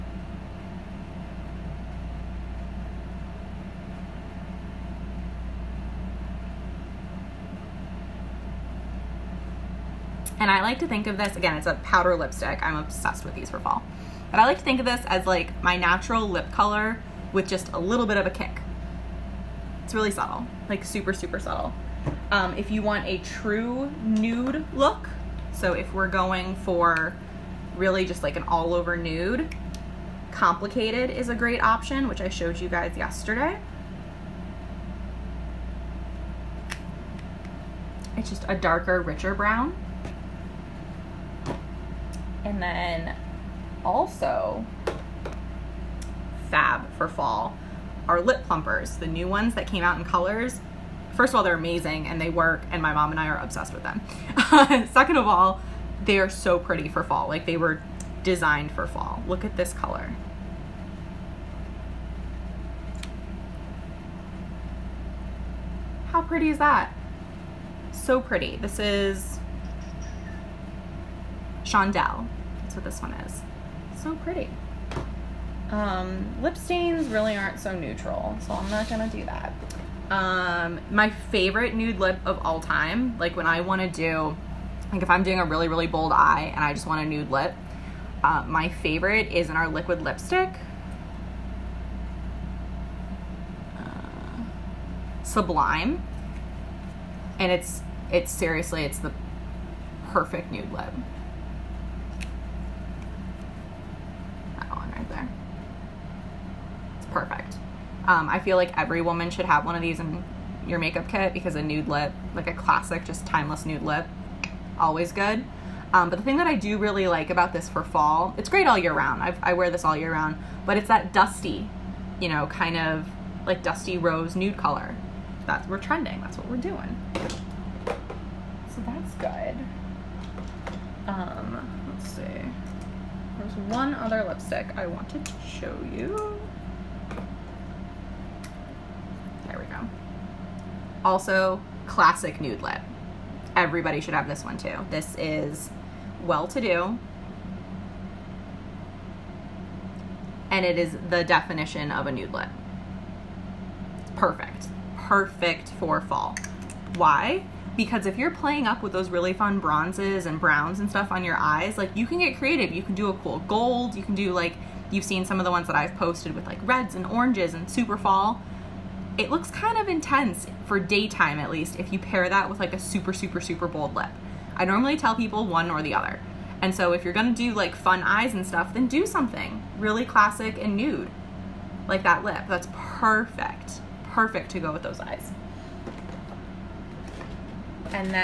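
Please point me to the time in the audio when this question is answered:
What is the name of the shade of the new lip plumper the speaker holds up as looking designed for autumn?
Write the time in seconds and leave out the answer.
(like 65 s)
71 s.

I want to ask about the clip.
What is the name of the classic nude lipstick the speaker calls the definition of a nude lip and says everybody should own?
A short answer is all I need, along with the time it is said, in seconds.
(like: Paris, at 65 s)
Well-to-do, at 146 s.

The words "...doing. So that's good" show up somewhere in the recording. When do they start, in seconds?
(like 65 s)
126 s.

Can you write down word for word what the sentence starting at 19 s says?
It's really subtle, like super, super subtle.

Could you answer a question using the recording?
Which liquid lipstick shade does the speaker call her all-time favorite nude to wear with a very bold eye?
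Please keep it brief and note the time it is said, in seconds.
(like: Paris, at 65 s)
Sublime, at 95 s.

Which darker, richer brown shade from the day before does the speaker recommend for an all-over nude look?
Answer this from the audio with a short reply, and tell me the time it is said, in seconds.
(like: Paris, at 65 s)
Complicated, at 30 s.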